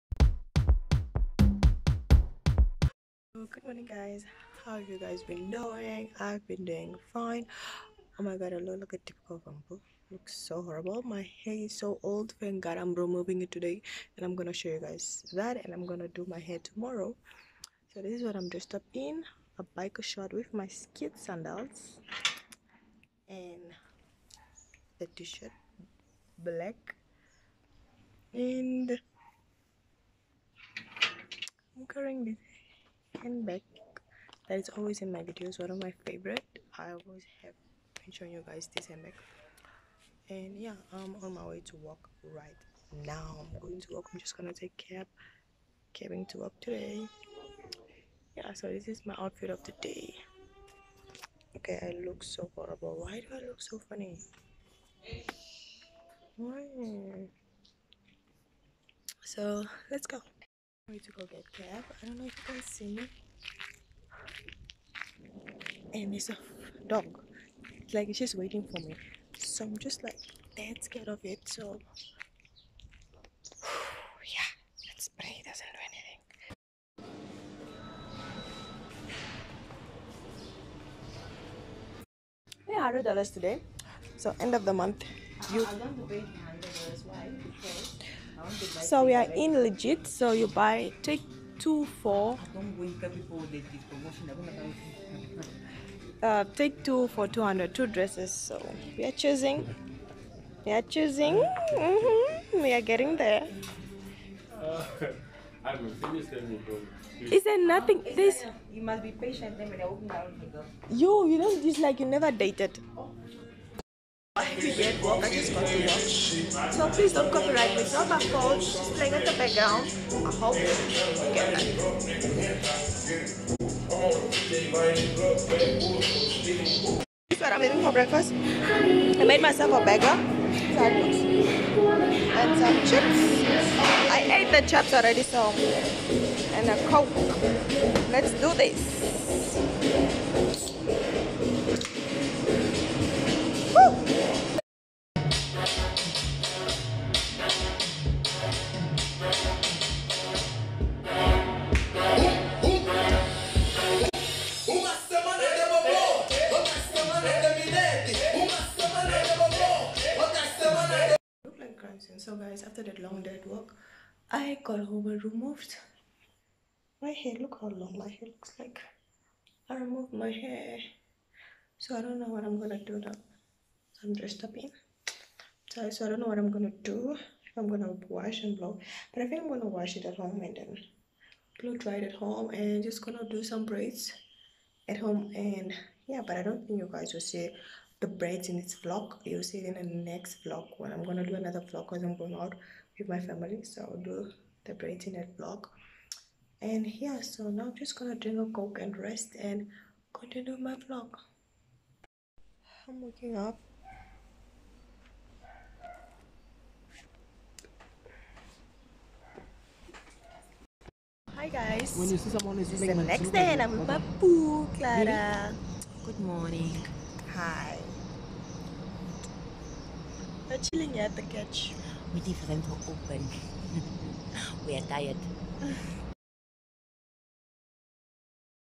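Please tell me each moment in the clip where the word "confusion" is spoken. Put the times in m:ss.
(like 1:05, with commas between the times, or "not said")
not said.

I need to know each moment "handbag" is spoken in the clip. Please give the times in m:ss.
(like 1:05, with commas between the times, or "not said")
0:33, 0:38.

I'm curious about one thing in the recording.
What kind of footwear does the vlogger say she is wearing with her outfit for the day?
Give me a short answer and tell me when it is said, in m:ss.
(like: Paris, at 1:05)
skid sandals, at 0:20.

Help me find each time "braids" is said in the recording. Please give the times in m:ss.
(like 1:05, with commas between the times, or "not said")
3:03, 3:08, 3:14.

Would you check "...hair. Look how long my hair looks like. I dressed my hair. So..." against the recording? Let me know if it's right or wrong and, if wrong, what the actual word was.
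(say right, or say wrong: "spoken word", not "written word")
wrong: "removed", not "dressed".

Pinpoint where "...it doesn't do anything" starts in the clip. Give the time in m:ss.
1:15.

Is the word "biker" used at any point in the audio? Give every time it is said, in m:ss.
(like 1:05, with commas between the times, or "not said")
0:19.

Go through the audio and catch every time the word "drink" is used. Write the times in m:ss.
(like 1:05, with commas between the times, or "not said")
3:18.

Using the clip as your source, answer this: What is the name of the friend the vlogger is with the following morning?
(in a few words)
Clara.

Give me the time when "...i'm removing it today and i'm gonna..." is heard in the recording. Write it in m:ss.
0:12.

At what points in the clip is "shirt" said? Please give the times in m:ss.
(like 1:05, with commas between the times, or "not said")
0:20, 0:25.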